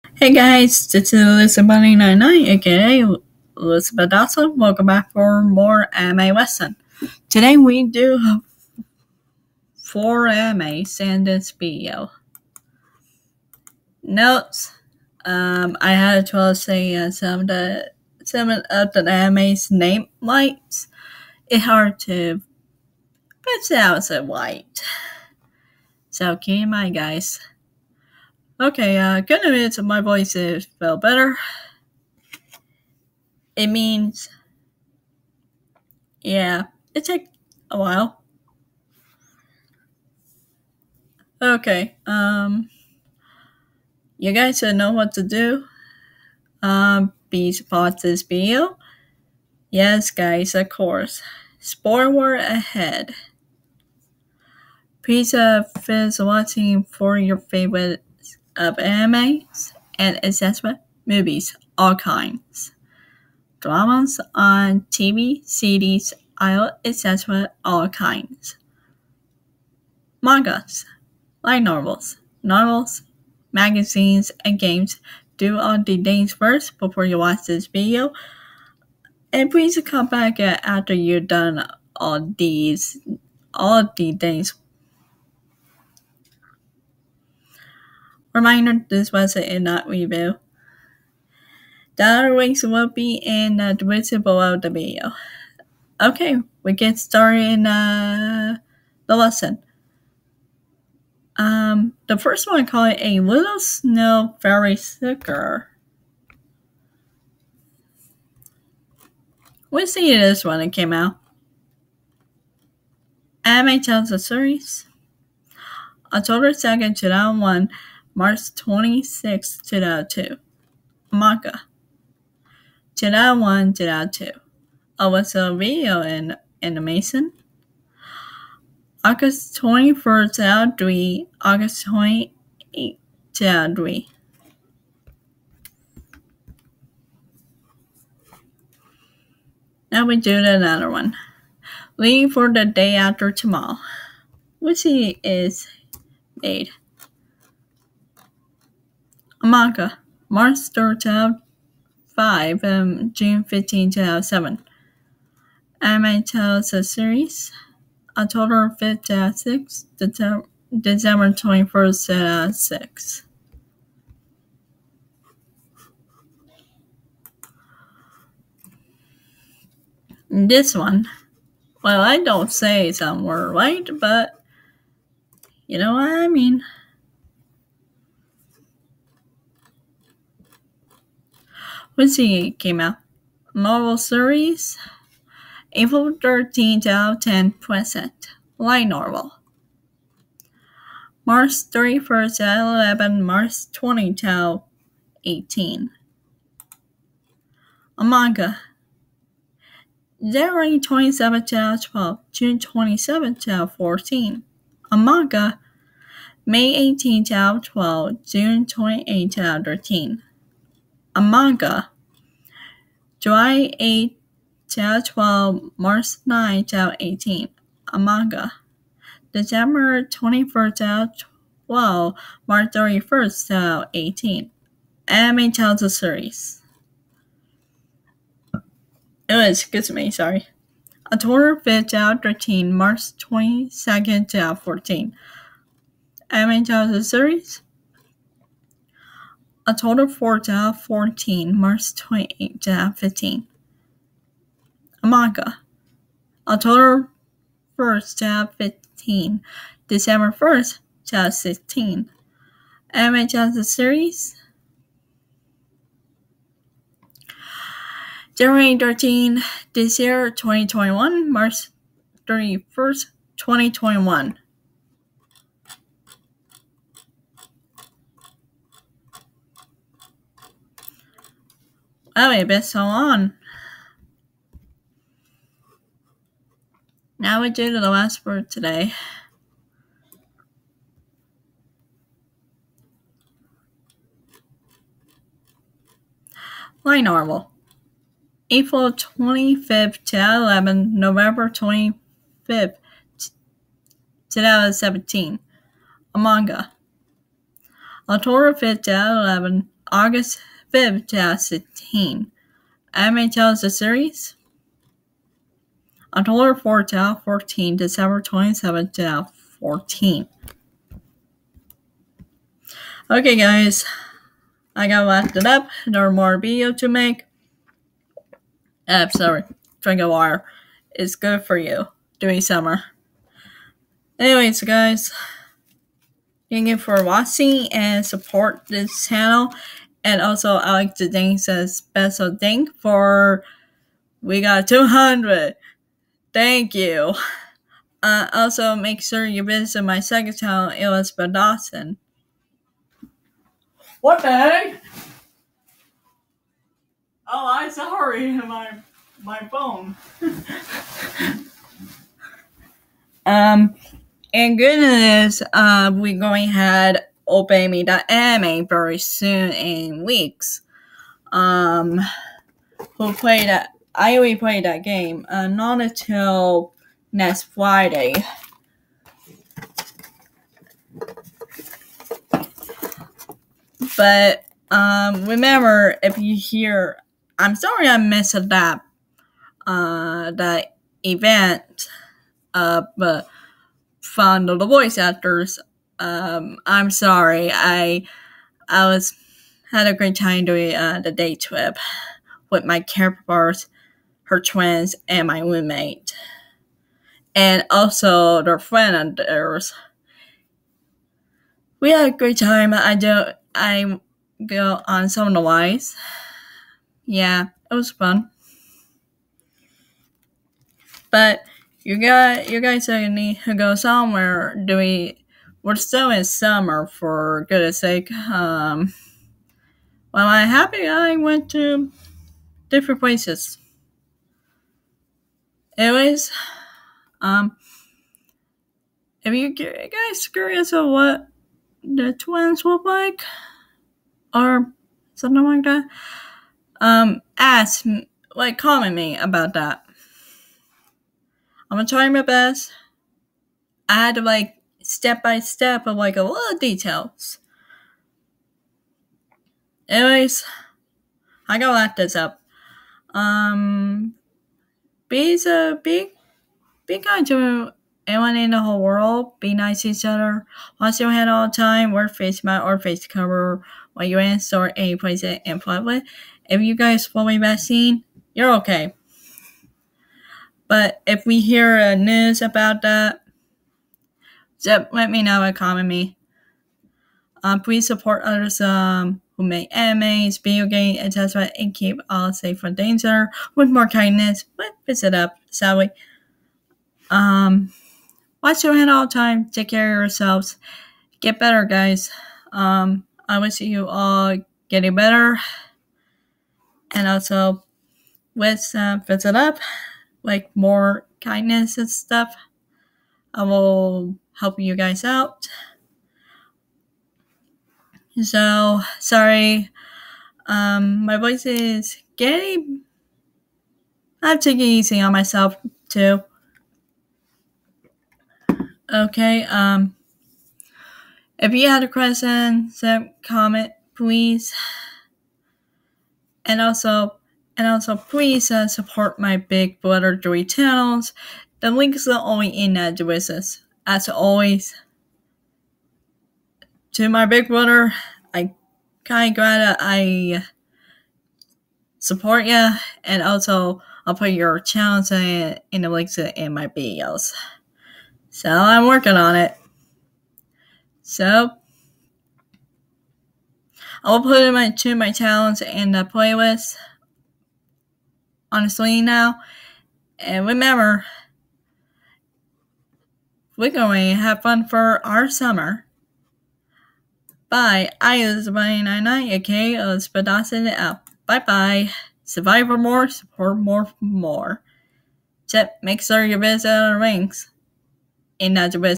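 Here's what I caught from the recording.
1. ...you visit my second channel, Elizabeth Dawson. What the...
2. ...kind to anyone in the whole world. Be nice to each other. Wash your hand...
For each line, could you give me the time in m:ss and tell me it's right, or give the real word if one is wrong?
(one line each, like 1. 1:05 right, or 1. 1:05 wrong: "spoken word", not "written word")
1. 5:39 right
2. 7:36 right.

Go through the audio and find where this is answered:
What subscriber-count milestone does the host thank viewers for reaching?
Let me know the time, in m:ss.
5:34.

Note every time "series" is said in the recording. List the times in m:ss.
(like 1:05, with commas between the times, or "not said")
1:54, 2:36, 3:03, 3:45, 3:57, 4:13, 5:03.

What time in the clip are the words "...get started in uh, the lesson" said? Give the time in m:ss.
1:36.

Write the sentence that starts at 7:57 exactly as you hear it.
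Uh, um, please support others um, who make animes, video games, etc.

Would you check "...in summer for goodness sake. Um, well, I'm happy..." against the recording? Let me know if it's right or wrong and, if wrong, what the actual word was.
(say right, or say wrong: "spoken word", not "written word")
right.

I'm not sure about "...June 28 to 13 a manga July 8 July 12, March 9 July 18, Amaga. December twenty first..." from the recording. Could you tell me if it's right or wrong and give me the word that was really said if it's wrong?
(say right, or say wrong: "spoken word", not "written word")
right.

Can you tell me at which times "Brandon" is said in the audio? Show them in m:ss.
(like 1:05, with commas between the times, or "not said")
not said.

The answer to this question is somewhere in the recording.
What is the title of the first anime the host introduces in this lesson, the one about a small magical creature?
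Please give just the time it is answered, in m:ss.
1:43.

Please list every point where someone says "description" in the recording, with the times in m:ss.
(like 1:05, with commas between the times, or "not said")
1:33, 8:52.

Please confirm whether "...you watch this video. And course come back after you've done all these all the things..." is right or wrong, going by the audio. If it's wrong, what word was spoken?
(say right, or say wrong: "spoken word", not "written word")
wrong: "please", not "course".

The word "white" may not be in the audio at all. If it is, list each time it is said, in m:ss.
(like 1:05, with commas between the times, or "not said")
0:24.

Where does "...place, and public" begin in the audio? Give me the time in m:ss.
7:44.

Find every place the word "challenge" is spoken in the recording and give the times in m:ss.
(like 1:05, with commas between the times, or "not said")
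9:15.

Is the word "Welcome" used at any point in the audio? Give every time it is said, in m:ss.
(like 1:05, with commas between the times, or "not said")
0:04.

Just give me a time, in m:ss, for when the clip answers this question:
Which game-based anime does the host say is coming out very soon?
5:57.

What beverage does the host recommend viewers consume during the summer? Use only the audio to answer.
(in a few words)
water.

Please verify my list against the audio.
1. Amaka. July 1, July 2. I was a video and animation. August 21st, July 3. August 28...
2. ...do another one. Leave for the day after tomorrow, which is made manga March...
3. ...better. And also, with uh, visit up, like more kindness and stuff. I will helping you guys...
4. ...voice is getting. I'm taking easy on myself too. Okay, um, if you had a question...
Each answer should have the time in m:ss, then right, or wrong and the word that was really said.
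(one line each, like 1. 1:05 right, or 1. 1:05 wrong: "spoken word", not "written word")
1. 2:01 right
2. 2:20 right
3. 8:14 right
4. 8:31 right.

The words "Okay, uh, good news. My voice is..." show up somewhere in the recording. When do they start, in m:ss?
0:28.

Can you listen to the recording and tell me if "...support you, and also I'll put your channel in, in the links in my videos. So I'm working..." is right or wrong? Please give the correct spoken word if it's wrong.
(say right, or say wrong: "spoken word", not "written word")
right.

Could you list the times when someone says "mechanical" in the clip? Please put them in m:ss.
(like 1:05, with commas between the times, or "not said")
not said.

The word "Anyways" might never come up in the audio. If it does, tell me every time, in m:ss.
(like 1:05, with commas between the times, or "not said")
5:24, 7:05, 7:29.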